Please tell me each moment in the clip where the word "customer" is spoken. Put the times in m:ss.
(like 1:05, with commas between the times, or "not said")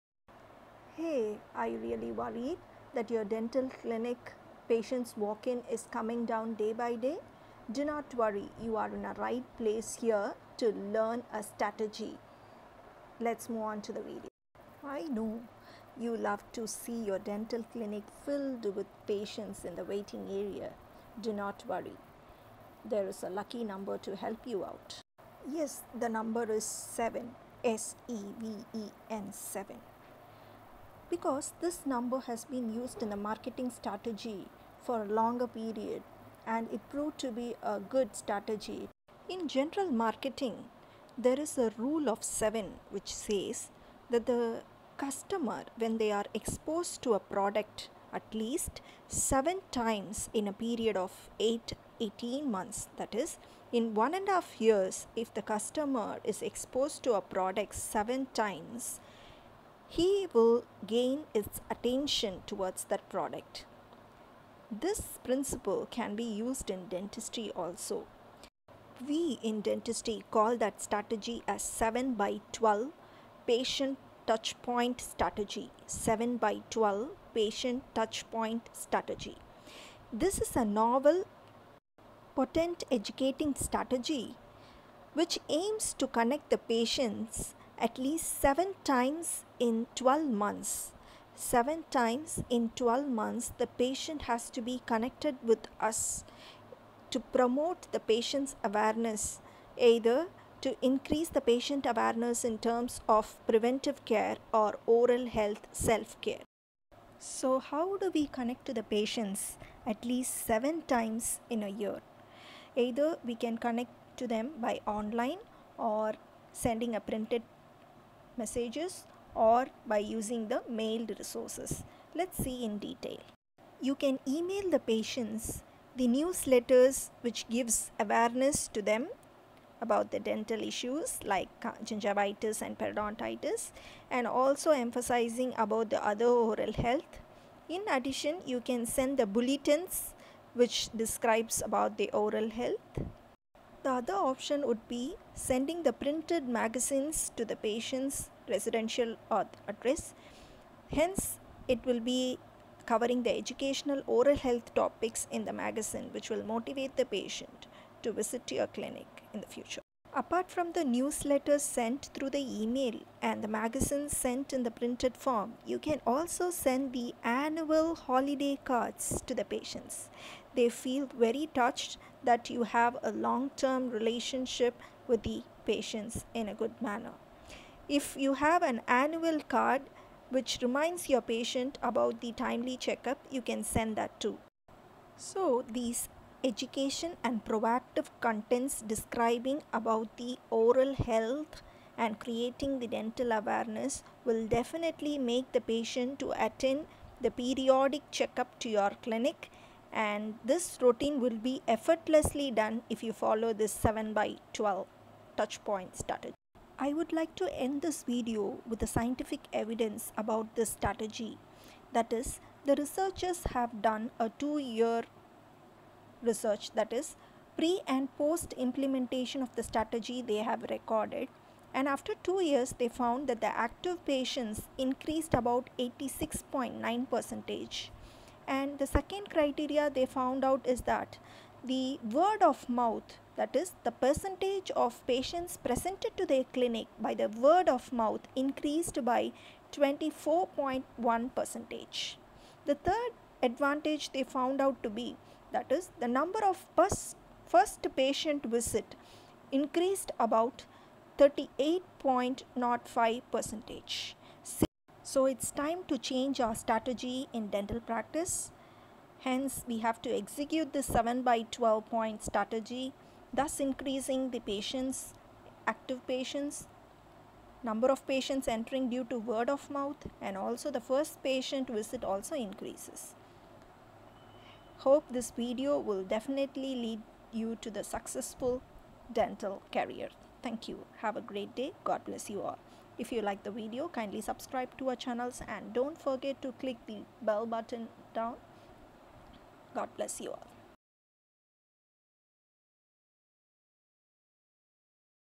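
0:44, 0:55.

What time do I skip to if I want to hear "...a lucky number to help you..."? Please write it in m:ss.
0:23.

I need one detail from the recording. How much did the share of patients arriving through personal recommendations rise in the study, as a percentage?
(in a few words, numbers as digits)
24.1%.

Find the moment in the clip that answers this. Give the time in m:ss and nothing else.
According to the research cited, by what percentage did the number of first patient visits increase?
4:11.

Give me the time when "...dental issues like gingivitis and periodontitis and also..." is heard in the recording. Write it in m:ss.
2:10.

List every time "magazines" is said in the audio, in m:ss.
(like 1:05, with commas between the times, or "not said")
2:26, 2:35, 2:43.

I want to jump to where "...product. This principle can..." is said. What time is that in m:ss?
1:03.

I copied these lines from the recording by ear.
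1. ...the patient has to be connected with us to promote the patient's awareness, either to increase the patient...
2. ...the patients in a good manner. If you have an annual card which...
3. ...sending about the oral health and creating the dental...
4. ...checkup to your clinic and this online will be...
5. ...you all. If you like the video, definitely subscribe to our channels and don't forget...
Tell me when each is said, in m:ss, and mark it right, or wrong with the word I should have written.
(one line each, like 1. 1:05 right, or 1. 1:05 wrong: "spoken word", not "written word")
1. 1:33 right
2. 2:55 right
3. 3:08 wrong: "describing", not "sending"
4. 3:18 wrong: "routine", not "online"
5. 4:42 wrong: "kindly", not "definitely".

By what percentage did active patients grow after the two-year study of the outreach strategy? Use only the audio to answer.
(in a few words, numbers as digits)
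86.9%.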